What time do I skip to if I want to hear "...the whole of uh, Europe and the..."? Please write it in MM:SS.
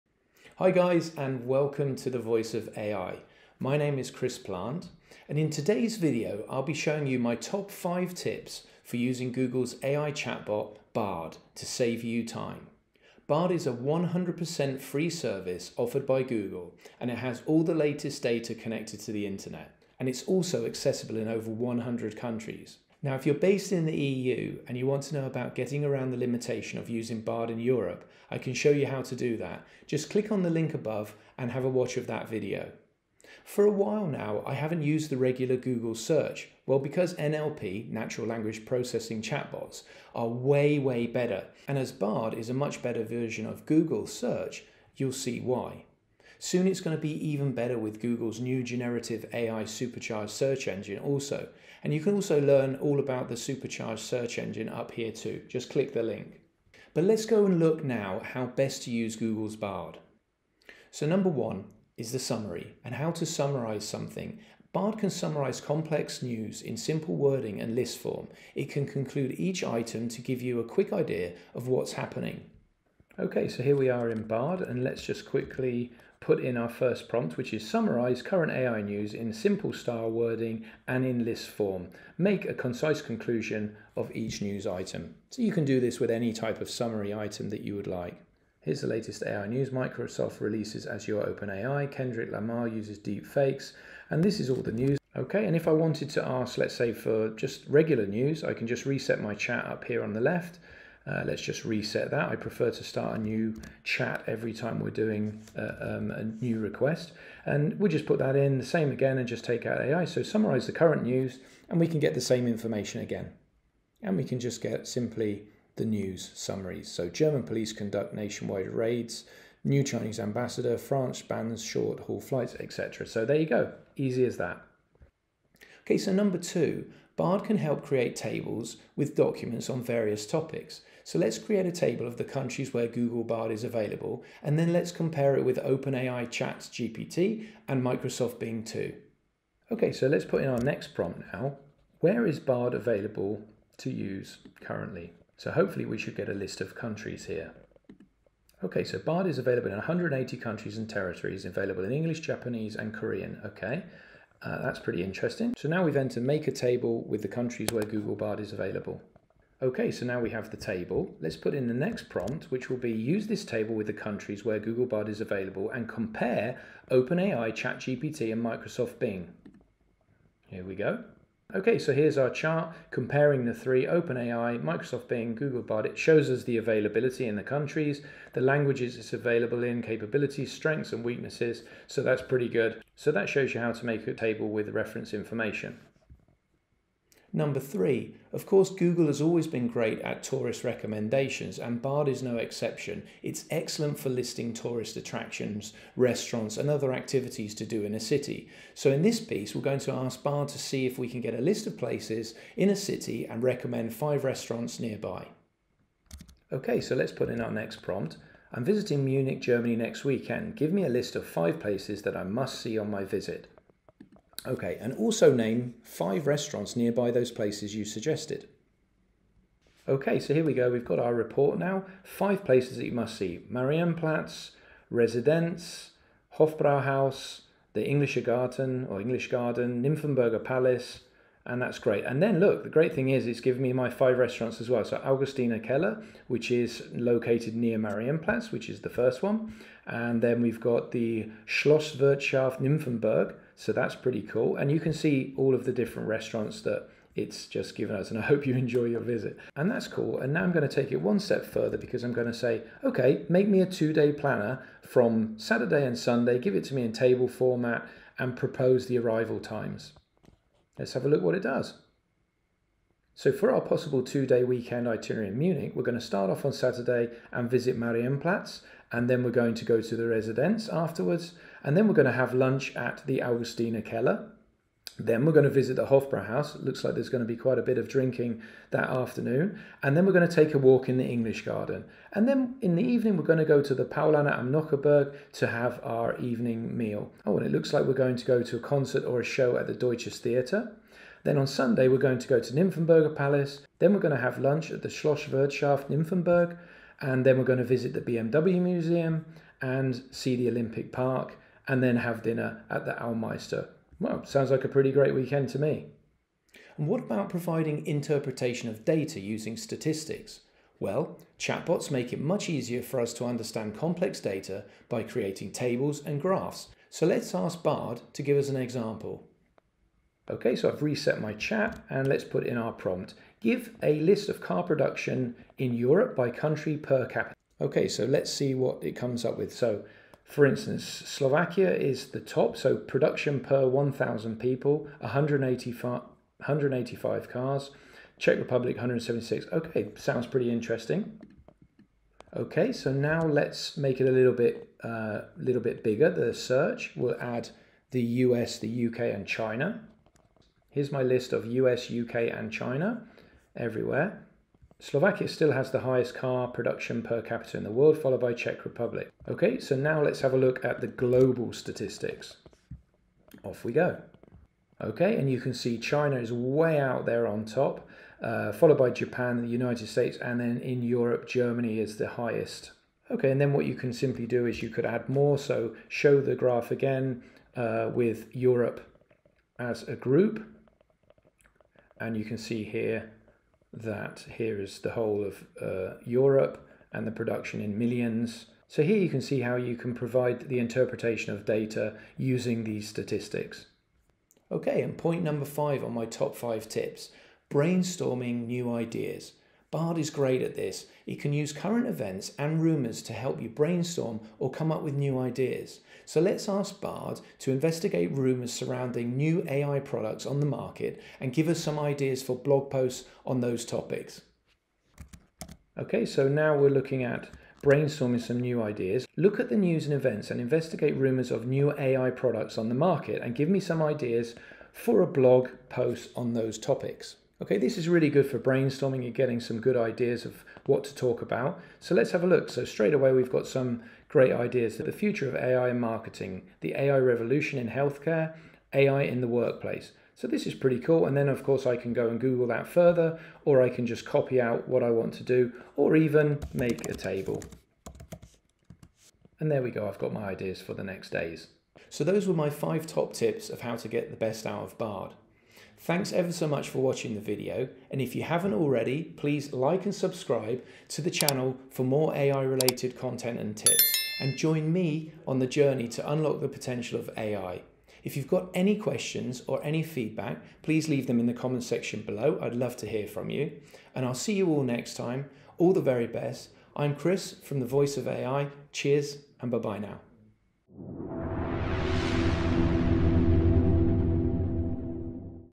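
06:24.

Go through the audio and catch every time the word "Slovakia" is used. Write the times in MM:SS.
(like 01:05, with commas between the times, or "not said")
05:30, 05:54.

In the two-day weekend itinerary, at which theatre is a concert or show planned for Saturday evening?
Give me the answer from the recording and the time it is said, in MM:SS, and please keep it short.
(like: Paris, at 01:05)
Deutsches Theater, at 04:49.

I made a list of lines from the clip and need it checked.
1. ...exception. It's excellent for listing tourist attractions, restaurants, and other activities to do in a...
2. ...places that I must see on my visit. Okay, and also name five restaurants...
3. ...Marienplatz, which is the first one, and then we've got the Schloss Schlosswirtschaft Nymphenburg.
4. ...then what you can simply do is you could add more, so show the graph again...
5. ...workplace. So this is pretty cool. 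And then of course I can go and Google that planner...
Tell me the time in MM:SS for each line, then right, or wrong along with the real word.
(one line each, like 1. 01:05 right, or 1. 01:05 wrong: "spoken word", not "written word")
1. 03:12 right
2. 03:31 right
3. 03:57 right
4. 06:13 right
5. 07:19 wrong: "further", not "planner".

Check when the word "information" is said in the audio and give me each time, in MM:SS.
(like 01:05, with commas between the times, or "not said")
01:52, 03:05.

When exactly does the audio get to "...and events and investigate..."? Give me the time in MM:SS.
06:59.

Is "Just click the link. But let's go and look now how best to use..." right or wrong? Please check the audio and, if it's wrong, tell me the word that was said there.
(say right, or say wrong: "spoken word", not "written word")
right.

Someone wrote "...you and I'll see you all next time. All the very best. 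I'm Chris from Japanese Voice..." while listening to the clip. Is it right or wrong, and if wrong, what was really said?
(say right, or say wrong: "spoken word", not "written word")
wrong: "The", not "Japanese".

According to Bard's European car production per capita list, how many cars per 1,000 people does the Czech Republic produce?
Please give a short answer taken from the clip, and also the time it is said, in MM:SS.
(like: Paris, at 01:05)
176, at 05:38.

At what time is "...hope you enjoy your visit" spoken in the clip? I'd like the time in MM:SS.
04:08.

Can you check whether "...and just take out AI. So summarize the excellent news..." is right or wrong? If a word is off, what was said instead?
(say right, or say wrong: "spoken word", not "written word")
wrong: "current", not "excellent".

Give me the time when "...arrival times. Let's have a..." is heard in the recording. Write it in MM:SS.
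04:18.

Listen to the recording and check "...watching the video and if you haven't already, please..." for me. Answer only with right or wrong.
right.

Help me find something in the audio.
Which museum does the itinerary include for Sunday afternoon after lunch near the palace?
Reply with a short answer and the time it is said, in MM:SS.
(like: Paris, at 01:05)
BMW Museum, at 04:58.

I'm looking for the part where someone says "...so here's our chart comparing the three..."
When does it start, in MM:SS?
02:51.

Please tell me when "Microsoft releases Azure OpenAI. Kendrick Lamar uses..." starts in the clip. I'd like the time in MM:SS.
01:29.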